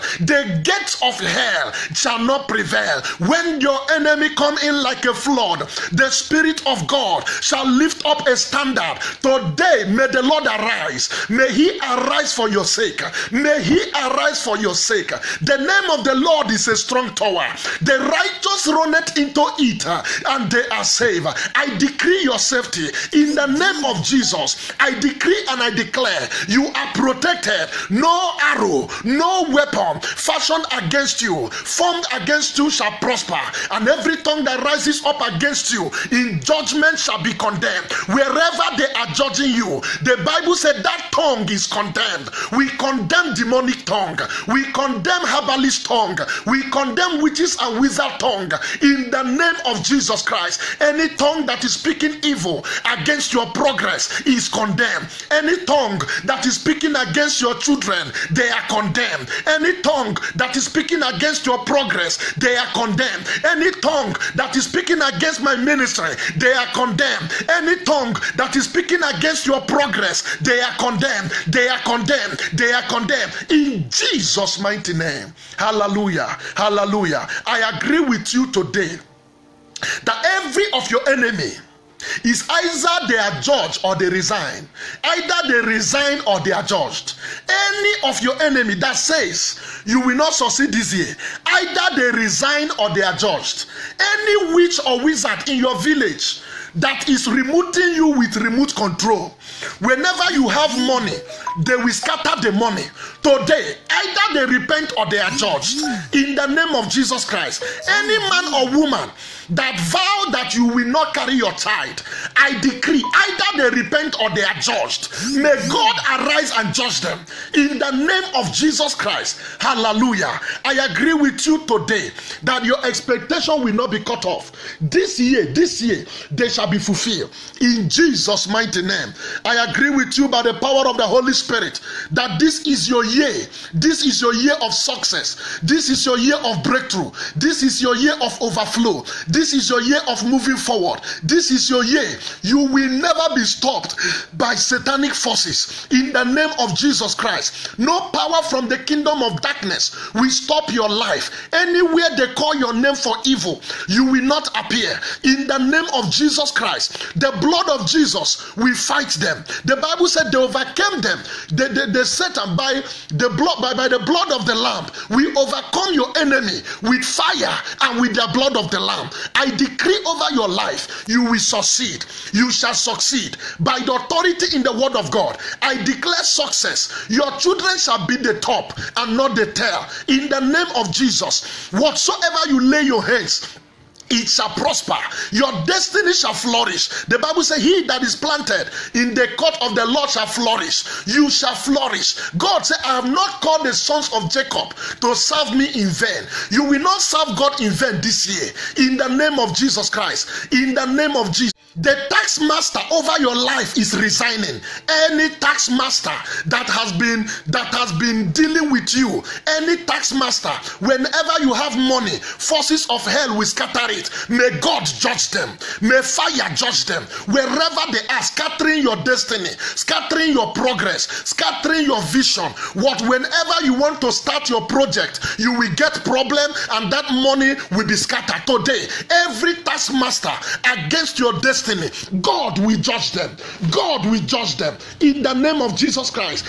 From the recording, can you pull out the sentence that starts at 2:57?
Your children shall be the top and not the tail.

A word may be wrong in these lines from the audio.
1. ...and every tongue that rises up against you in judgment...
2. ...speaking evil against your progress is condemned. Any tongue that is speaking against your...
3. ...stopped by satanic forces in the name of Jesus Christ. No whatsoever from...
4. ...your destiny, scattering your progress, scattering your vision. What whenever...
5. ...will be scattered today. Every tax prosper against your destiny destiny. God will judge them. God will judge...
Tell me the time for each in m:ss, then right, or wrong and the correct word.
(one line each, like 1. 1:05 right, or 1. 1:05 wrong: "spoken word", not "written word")
1. 0:33 right
2. 0:51 right
3. 2:23 wrong: "power", not "whatsoever"
4. 3:38 right
5. 3:47 wrong: "master", not "prosper".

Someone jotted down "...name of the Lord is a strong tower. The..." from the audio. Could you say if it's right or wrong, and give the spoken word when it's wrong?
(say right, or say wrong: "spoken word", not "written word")
right.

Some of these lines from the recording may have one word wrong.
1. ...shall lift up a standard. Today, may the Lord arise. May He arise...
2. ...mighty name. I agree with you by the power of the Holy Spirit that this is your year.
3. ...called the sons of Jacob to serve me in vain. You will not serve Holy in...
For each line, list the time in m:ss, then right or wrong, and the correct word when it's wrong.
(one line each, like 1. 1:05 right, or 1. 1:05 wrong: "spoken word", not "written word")
1. 0:07 right
2. 2:08 right
3. 3:13 wrong: "God", not "Holy".